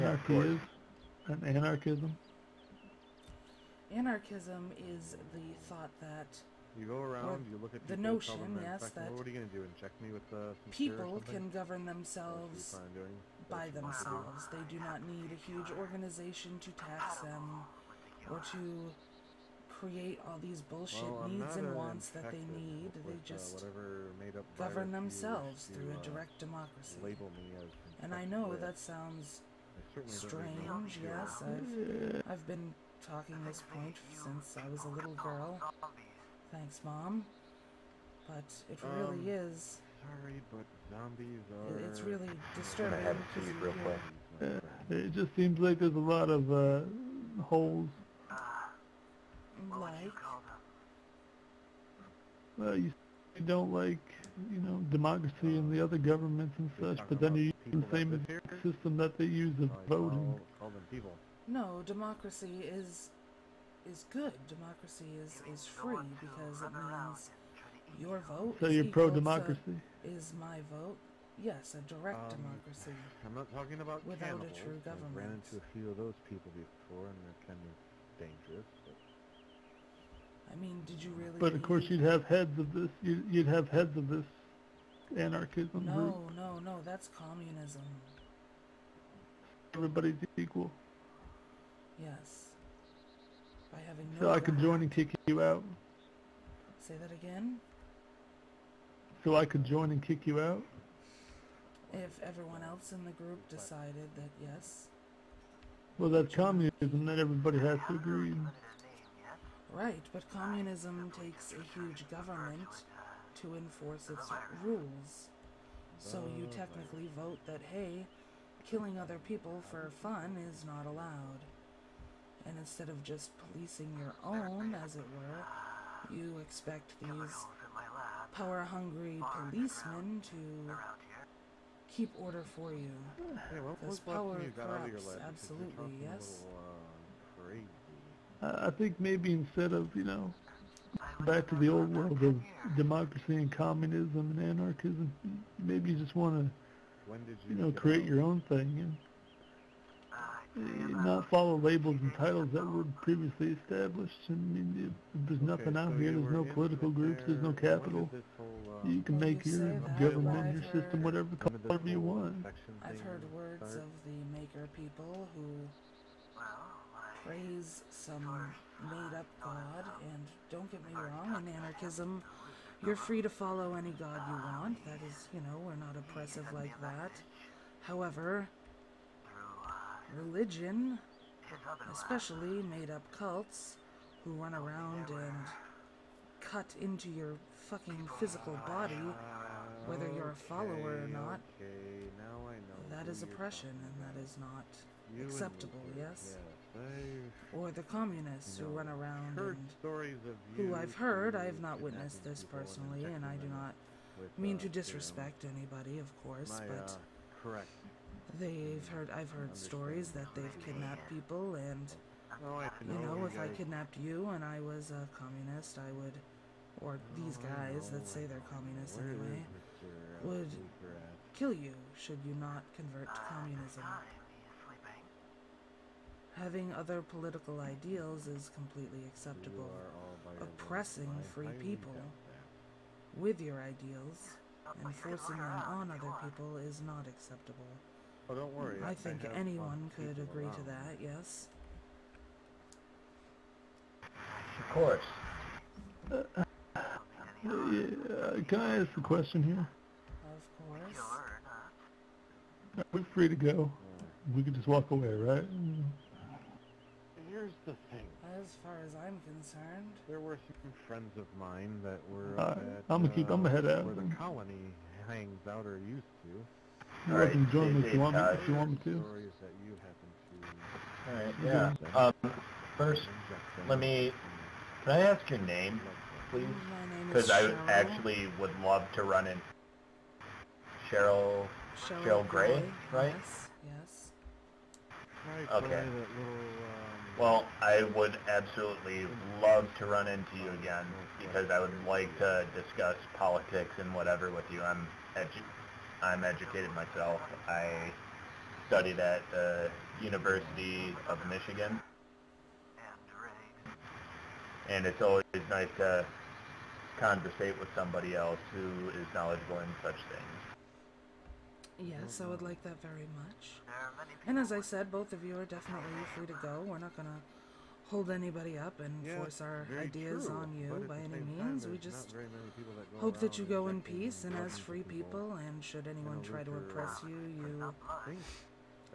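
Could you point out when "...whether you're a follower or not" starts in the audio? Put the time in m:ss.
3:09.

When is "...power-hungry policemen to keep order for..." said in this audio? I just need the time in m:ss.
2:08.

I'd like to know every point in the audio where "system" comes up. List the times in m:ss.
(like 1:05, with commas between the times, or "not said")
0:58, 2:40.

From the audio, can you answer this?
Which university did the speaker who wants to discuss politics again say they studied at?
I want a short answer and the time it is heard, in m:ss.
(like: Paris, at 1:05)
University of Michigan, at 5:00.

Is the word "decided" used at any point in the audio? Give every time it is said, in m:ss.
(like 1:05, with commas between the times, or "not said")
1:43.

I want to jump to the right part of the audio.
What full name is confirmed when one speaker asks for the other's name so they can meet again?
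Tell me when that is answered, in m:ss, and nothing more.
4:42.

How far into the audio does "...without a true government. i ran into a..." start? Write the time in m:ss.
1:14.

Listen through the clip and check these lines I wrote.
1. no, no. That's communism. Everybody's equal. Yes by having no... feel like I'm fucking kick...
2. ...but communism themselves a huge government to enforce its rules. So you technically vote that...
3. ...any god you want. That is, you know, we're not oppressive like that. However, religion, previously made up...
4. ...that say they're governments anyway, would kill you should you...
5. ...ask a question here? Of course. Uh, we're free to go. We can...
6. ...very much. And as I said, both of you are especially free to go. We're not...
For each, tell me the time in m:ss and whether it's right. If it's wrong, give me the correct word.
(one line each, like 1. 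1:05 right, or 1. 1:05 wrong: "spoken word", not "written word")
1. 1:26 wrong: "joining", not "fucking"
2. 1:50 wrong: "takes", not "themselves"
3. 2:53 wrong: "especially", not "previously"
4. 3:37 wrong: "communists", not "governments"
5. 4:08 right
6. 5:12 wrong: "definitely", not "especially".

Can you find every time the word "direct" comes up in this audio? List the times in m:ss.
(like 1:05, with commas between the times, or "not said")
0:26, 1:11.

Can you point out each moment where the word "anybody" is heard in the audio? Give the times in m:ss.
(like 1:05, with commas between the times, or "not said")
3:25, 5:18.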